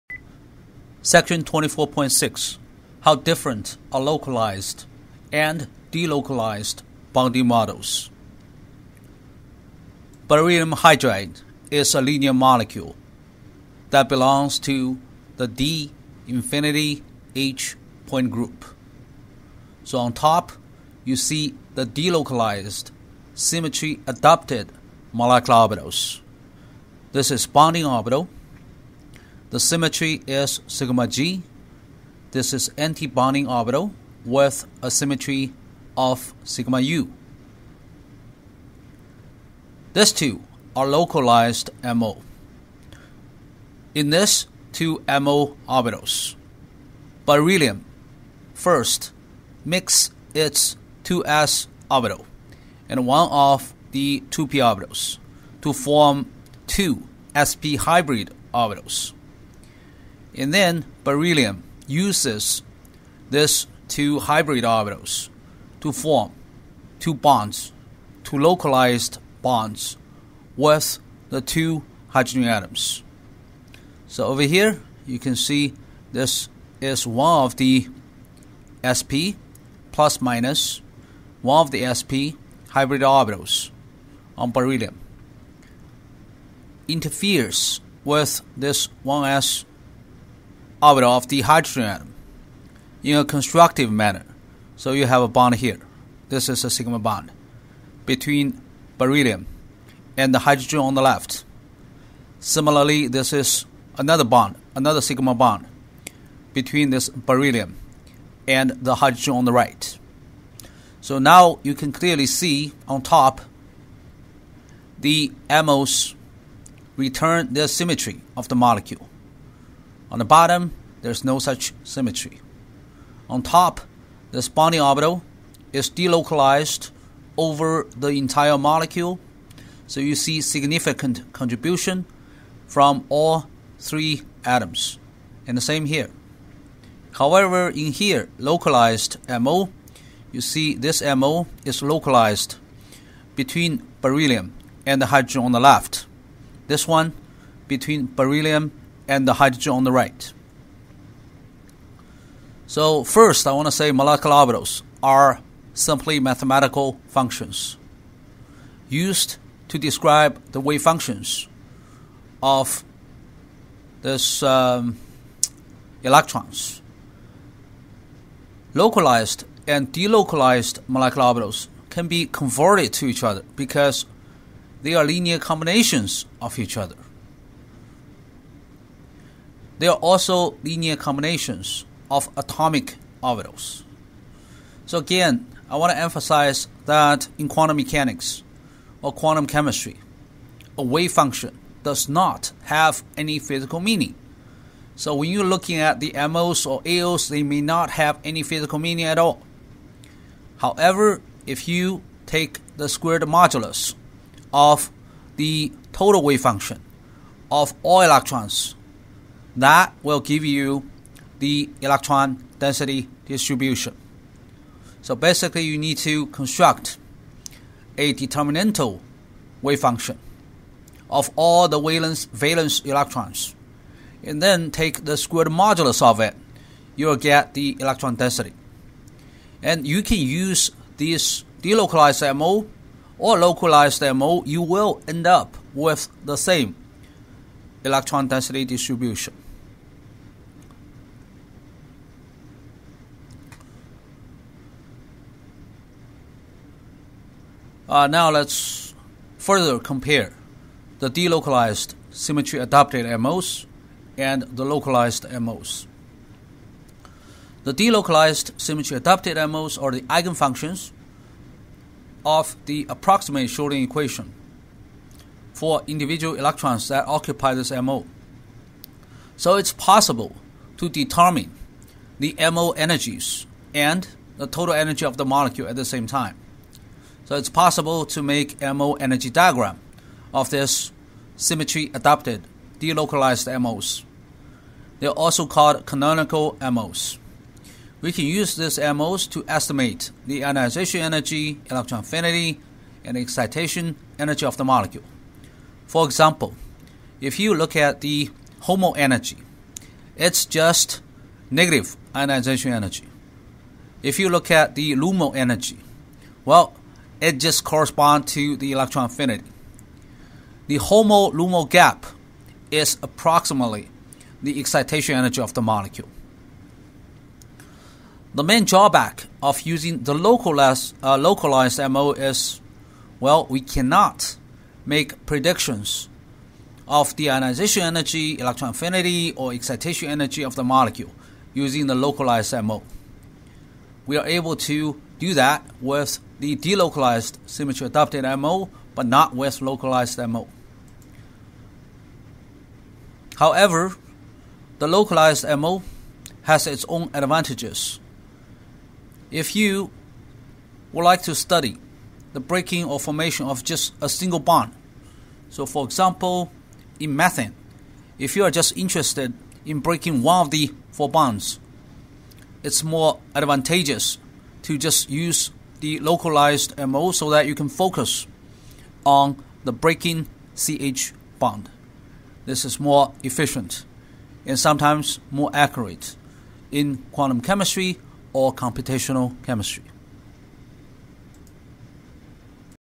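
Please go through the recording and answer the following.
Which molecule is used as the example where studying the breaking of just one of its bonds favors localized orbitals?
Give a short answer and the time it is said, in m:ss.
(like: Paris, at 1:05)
methane, at 5:57.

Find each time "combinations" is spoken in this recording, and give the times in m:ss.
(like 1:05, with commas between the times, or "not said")
2:55, 3:00.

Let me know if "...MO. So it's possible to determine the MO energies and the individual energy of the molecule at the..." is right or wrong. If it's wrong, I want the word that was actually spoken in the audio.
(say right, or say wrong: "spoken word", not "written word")
wrong: "total", not "individual".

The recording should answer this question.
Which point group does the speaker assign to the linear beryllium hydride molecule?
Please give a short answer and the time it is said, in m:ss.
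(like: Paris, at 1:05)
D infinity h, at 0:15.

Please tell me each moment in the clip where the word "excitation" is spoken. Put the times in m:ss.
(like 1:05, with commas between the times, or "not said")
4:53, 5:14, 5:29.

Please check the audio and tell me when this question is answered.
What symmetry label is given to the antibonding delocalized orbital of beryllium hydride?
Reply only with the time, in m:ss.
0:36.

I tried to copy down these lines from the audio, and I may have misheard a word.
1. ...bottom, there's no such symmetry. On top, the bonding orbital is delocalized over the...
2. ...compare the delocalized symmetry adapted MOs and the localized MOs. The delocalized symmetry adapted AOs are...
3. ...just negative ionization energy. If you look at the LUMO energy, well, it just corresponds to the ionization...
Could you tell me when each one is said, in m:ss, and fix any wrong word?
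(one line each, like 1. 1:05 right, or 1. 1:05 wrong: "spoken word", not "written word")
1. 2:00 right
2. 4:09 wrong: "MOs", not "AOs"
3. 5:00 wrong: "electron", not "ionization".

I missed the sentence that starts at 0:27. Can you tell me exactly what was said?
This is bonding orbital the symmetry is sigma g.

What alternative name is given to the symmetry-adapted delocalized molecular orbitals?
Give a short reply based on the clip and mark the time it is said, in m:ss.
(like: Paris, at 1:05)
canonical MOs, at 4:45.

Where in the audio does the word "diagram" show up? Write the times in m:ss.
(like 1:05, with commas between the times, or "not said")
4:39.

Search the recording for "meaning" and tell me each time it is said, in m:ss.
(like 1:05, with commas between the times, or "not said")
3:13, 3:18.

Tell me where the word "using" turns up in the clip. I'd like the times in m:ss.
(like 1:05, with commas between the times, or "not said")
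5:19, 5:31.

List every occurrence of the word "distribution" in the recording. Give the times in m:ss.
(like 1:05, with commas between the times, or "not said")
3:33, 3:58.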